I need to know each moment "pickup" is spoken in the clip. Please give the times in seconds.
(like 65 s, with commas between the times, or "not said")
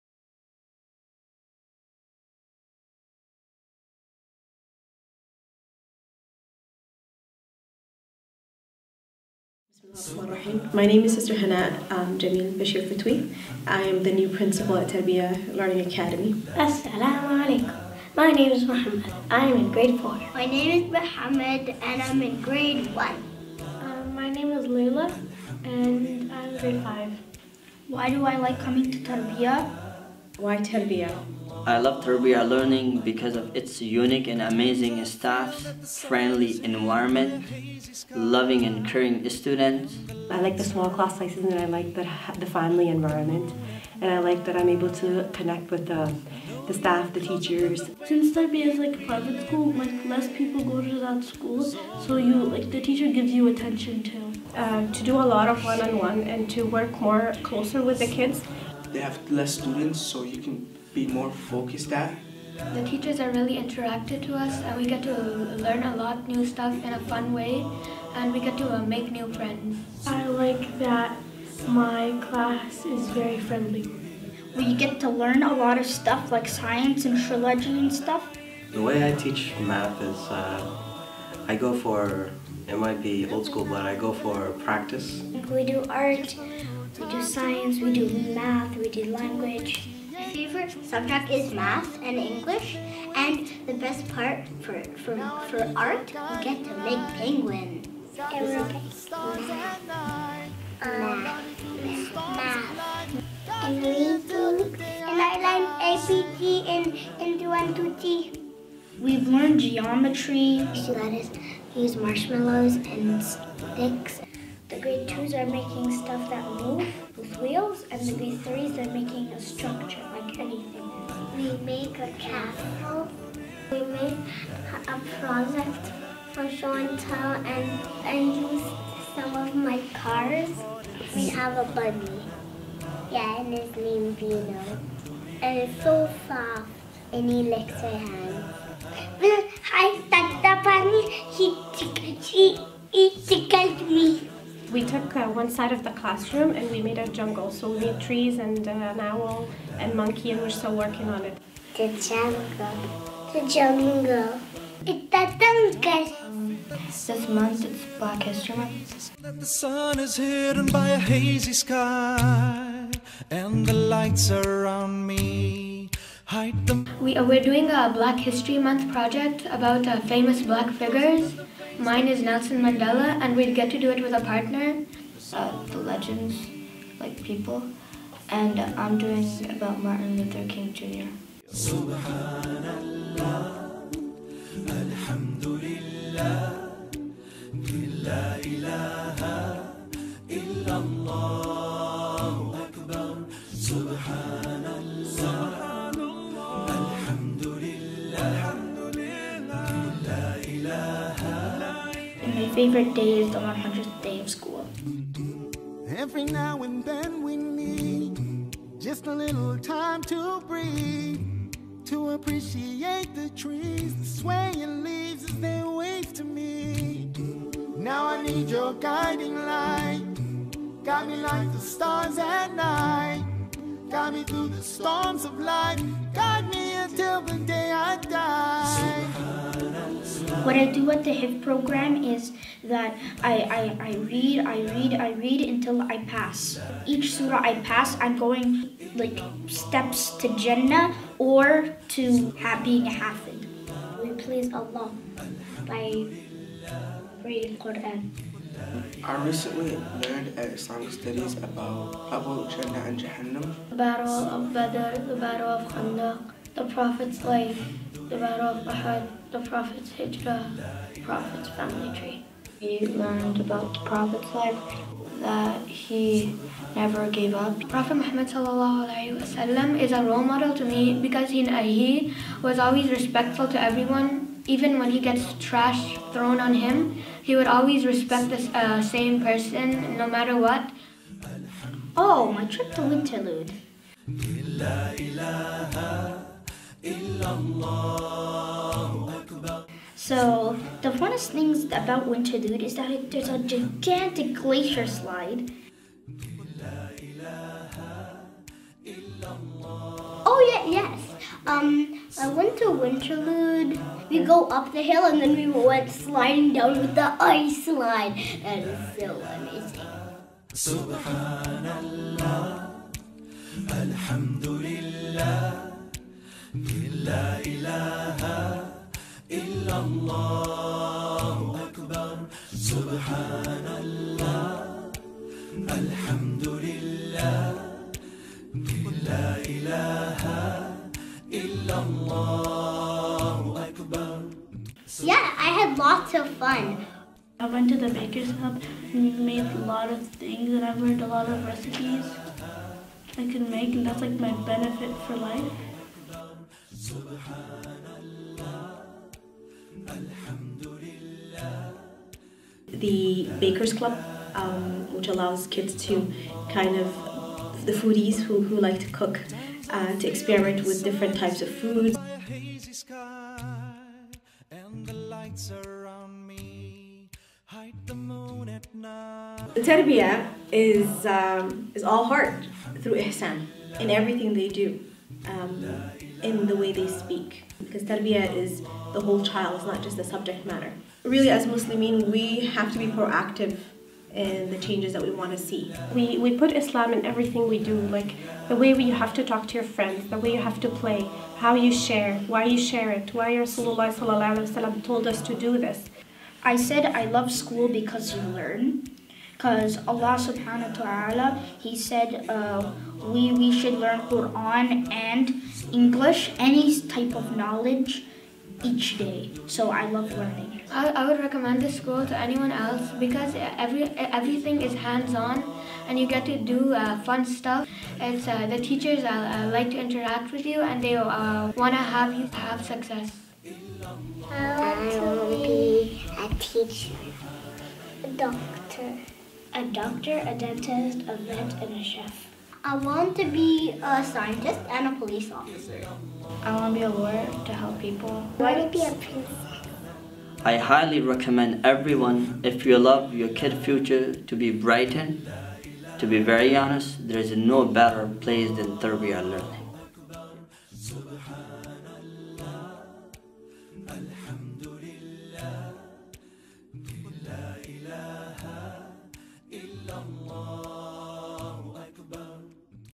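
not said.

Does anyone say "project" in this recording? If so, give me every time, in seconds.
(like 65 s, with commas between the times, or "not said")
125 s, 168 s.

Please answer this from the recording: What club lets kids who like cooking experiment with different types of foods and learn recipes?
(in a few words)
The Bakers Club.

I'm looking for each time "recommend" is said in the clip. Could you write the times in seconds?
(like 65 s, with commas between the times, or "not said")
411 s, 441 s.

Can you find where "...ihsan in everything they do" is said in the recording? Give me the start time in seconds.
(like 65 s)
372 s.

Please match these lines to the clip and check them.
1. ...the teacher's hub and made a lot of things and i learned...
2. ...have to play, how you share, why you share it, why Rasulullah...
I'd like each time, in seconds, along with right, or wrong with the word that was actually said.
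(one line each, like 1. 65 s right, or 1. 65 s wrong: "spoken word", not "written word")
1. 337 s wrong: "baker", not "teacher"
2. 390 s right.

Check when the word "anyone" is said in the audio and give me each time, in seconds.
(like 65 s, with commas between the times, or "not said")
412 s.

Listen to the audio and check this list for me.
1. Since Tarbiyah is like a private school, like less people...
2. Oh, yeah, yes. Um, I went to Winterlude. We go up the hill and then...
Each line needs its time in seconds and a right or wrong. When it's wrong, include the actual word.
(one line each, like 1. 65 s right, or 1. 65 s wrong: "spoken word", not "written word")
1. 48 s right
2. 300 s right.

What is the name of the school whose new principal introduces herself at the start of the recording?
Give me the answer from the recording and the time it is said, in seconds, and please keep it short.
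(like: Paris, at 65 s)
Tarbiyah Learning Academy, at 14 s.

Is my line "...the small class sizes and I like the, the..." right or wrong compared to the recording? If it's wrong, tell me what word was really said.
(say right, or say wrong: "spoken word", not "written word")
right.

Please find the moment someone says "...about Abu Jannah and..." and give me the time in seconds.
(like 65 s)
251 s.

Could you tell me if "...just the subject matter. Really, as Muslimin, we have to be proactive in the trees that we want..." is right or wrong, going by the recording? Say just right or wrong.
wrong.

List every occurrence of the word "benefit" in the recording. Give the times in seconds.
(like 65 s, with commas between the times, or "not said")
344 s.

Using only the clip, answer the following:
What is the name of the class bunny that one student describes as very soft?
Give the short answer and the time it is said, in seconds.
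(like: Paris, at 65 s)
Vino, at 134 s.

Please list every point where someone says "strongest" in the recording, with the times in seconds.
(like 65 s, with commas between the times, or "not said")
not said.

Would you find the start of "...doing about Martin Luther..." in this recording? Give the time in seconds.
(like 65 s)
178 s.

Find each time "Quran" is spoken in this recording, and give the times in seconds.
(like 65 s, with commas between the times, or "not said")
247 s, 404 s.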